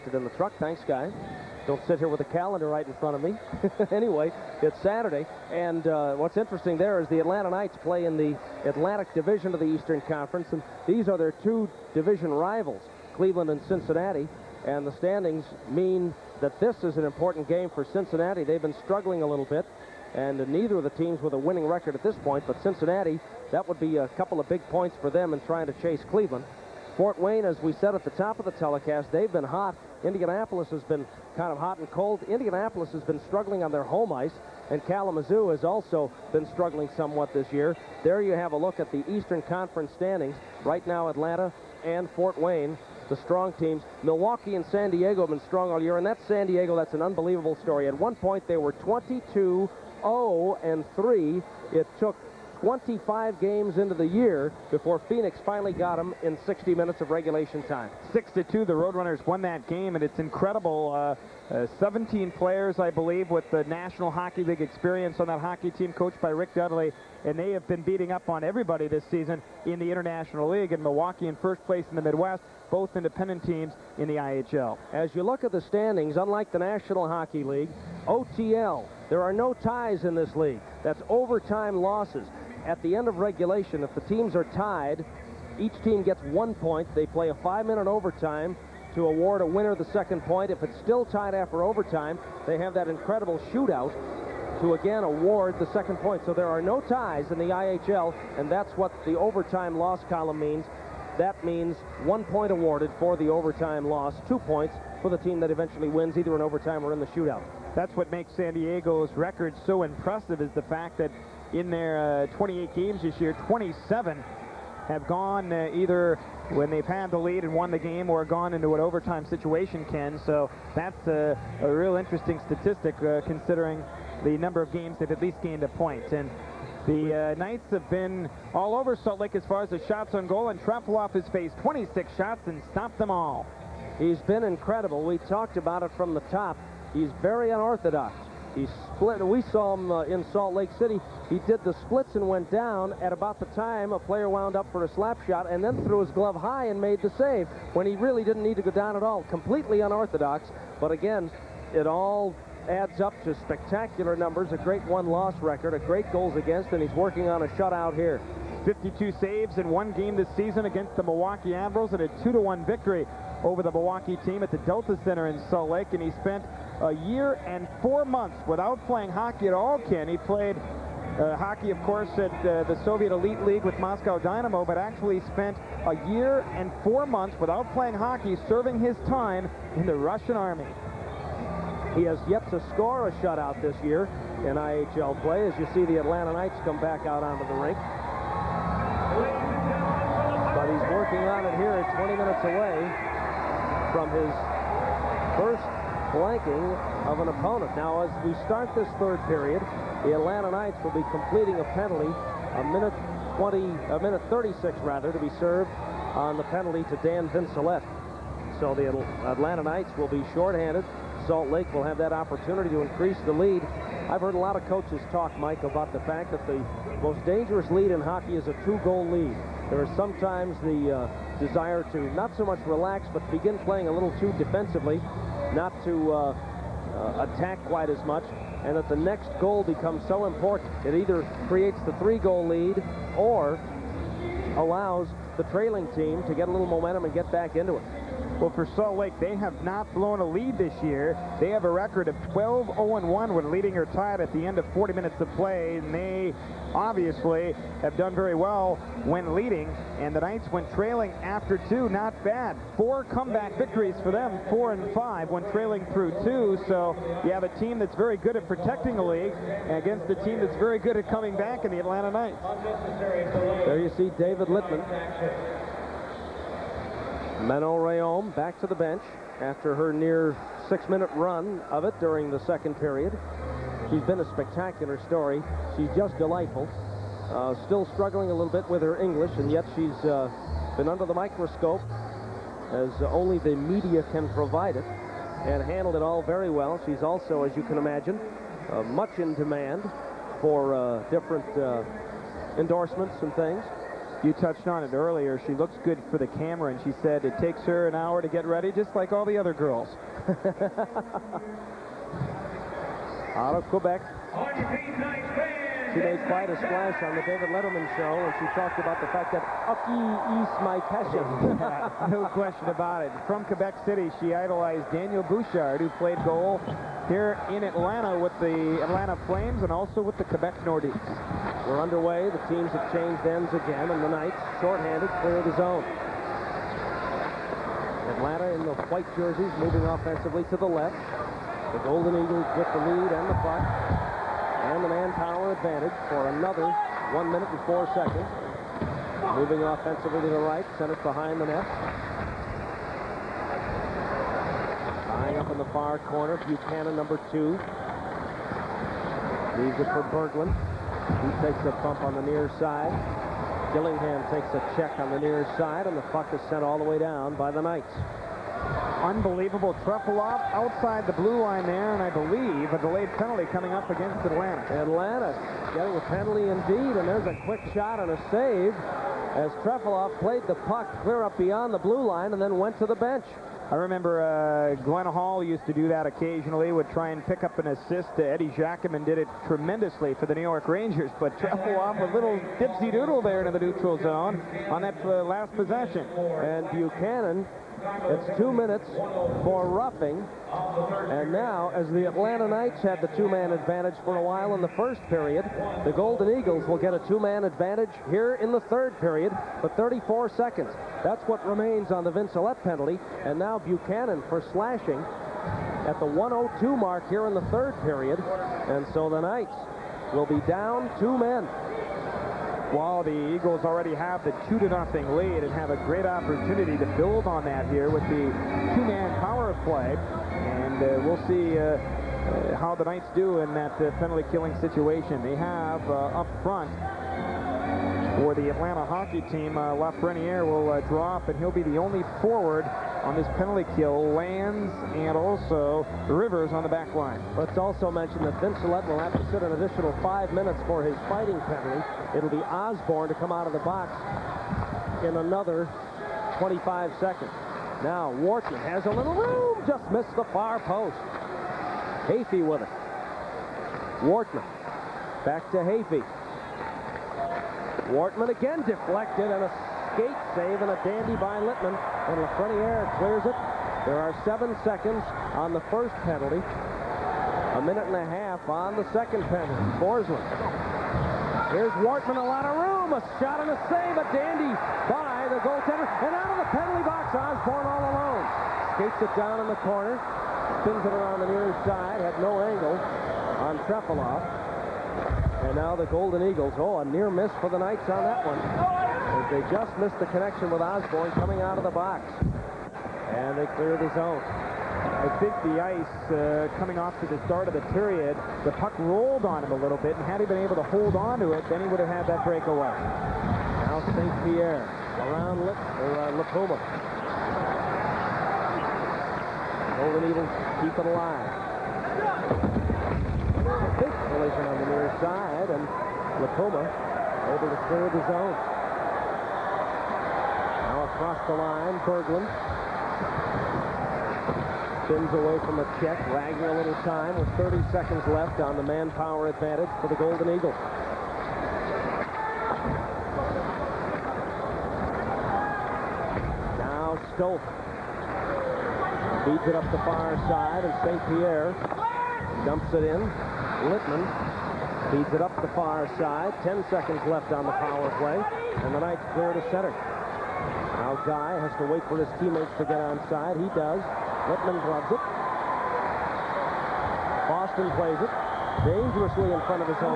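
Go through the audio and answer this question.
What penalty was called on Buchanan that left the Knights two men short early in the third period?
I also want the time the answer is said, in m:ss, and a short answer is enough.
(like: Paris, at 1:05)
Slashing, at 6:44.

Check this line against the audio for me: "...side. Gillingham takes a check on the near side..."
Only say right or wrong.
right.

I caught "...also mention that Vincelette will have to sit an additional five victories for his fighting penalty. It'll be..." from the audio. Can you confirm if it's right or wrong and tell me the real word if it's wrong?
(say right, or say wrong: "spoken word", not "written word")
wrong: "minutes", not "victories".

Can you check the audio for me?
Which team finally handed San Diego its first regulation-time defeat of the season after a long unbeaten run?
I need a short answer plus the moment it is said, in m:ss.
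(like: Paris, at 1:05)
Phoenix, at 0:55.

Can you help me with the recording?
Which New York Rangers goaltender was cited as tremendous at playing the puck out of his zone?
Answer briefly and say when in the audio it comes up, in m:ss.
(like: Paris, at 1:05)
Eddie Giacomin, at 6:18.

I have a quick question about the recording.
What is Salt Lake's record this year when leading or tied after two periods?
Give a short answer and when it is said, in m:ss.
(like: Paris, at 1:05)
12-0-1, at 4:02.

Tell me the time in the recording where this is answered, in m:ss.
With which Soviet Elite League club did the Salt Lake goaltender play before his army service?
2:53.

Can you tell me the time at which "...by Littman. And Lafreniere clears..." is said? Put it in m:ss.
7:41.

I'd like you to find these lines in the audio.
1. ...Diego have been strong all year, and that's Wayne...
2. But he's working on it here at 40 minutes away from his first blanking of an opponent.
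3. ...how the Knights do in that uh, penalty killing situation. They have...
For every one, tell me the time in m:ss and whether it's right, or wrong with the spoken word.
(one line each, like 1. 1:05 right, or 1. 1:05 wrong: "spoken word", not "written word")
1. 0:44 wrong: "San", not "Wayne"
2. 3:10 wrong: "20", not "40"
3. 7:02 right.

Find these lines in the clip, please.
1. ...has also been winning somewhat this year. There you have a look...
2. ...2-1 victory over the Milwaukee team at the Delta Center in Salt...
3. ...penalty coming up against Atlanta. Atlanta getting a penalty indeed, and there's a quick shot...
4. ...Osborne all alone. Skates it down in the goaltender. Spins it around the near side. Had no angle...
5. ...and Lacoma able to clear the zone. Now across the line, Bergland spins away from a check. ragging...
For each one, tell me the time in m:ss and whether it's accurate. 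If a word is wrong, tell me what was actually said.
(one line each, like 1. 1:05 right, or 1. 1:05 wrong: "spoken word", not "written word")
1. 0:35 wrong: "struggling", not "winning"
2. 2:42 right
3. 6:03 right
4. 7:57 wrong: "corner", not "goaltender"
5. 8:35 right.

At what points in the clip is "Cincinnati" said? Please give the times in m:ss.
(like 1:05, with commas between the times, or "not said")
0:13, 0:17, 0:22.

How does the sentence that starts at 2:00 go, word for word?
So that's a, a real interesting statistic uh, considering the number of games they've at least gained a point.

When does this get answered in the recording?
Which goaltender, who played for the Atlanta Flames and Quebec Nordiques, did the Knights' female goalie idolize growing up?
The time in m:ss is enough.
5:14.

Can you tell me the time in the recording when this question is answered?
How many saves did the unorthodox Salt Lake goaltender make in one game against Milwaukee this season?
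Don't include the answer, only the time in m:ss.
2:38.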